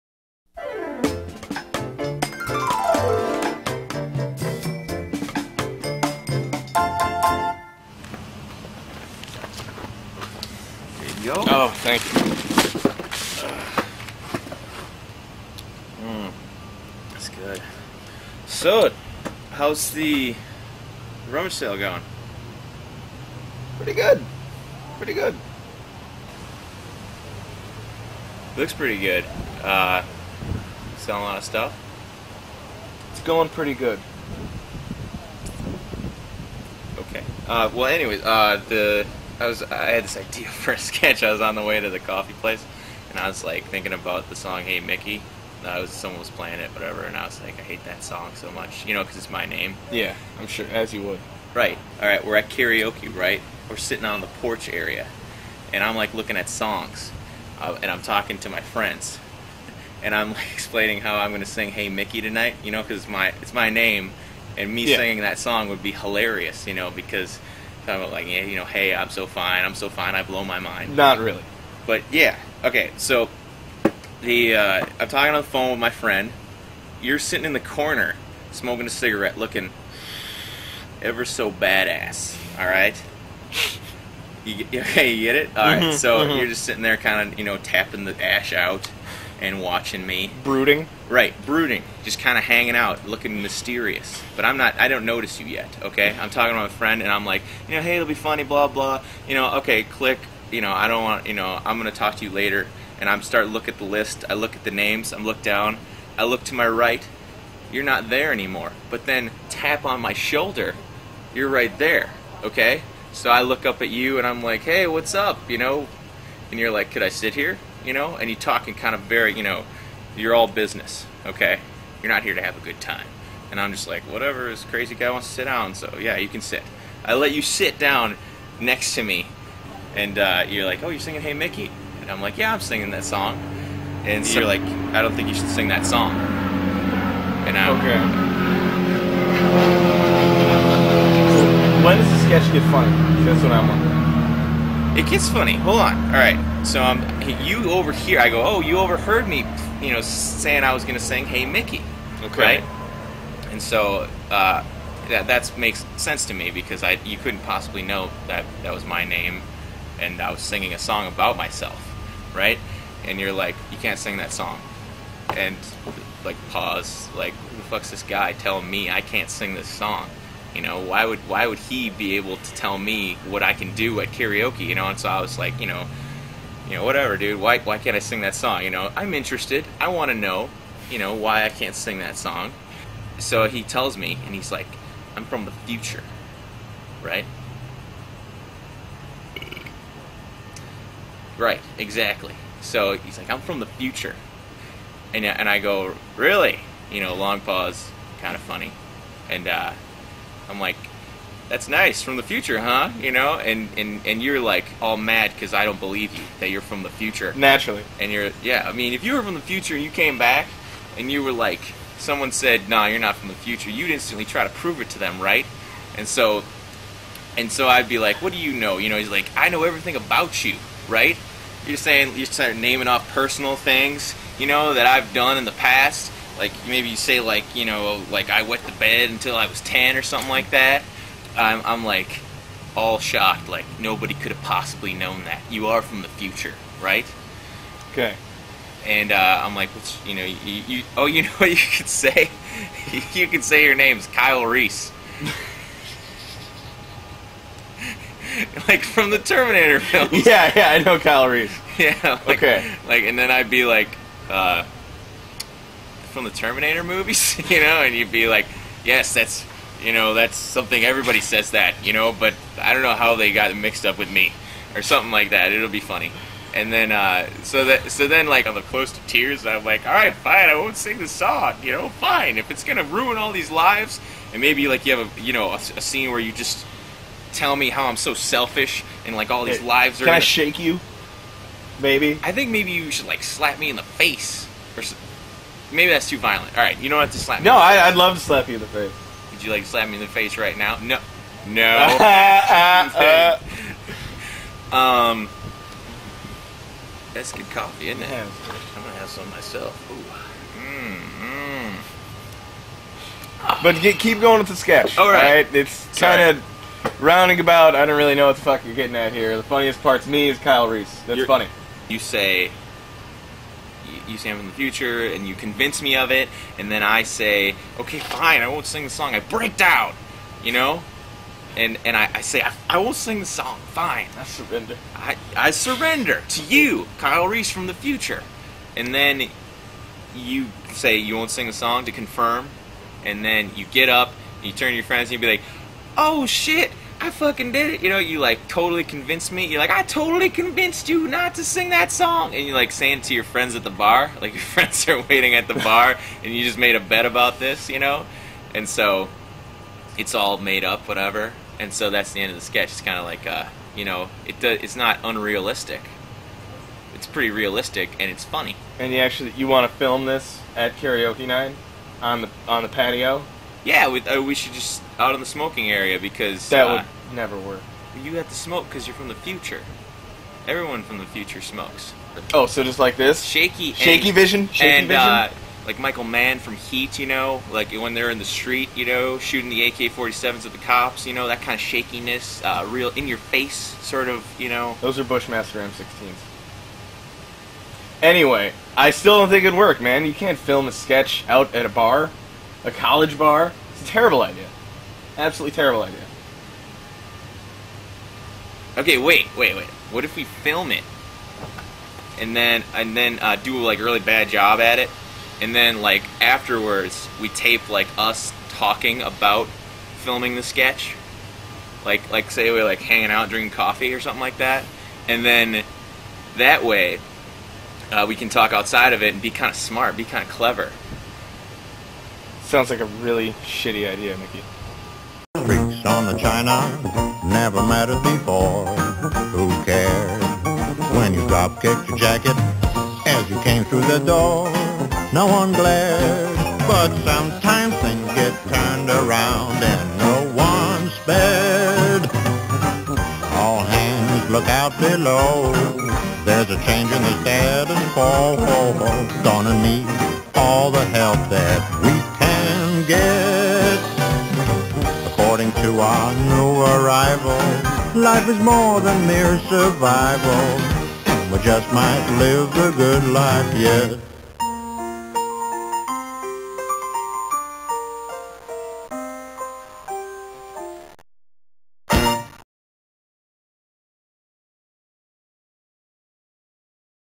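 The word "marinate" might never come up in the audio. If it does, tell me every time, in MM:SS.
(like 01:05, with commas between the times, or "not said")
not said.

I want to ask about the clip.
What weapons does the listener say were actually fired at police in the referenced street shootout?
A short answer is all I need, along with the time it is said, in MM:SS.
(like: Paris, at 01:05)
Bushmaster M16s, at 06:25.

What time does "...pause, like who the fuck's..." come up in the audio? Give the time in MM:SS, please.
02:46.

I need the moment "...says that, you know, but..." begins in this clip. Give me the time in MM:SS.
04:21.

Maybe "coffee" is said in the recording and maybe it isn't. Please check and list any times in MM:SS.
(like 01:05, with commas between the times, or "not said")
00:41, 04:57, 06:53.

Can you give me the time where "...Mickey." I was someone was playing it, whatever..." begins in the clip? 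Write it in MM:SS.
00:44.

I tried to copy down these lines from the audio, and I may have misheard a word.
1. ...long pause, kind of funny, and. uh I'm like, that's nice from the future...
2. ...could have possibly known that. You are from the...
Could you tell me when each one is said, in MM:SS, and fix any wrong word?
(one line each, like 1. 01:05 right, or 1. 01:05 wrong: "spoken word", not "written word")
1. 03:17 right
2. 03:54 right.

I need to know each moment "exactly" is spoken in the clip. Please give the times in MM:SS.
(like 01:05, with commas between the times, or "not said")
03:11.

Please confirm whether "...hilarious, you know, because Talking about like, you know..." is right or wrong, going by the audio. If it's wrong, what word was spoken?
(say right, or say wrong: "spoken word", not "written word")
right.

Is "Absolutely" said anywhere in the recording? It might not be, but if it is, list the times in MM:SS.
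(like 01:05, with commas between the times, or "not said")
06:35.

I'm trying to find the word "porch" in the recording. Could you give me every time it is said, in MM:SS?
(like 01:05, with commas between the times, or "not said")
00:54.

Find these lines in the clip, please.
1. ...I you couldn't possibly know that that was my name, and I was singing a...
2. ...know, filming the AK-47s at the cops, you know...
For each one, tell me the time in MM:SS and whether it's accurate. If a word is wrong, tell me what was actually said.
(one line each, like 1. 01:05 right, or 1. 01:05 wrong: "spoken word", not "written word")
1. 02:36 right
2. 06:18 wrong: "shooting", not "filming".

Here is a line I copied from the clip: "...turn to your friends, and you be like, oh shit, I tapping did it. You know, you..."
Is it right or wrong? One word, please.
wrong.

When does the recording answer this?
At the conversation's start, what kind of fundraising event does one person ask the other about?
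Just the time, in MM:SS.
00:21.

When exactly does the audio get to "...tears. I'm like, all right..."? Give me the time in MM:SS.
04:29.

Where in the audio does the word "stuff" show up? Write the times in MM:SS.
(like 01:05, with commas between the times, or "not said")
00:31.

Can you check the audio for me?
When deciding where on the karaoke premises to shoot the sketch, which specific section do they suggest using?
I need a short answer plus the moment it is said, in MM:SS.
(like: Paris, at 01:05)
The smoking area, at 06:05.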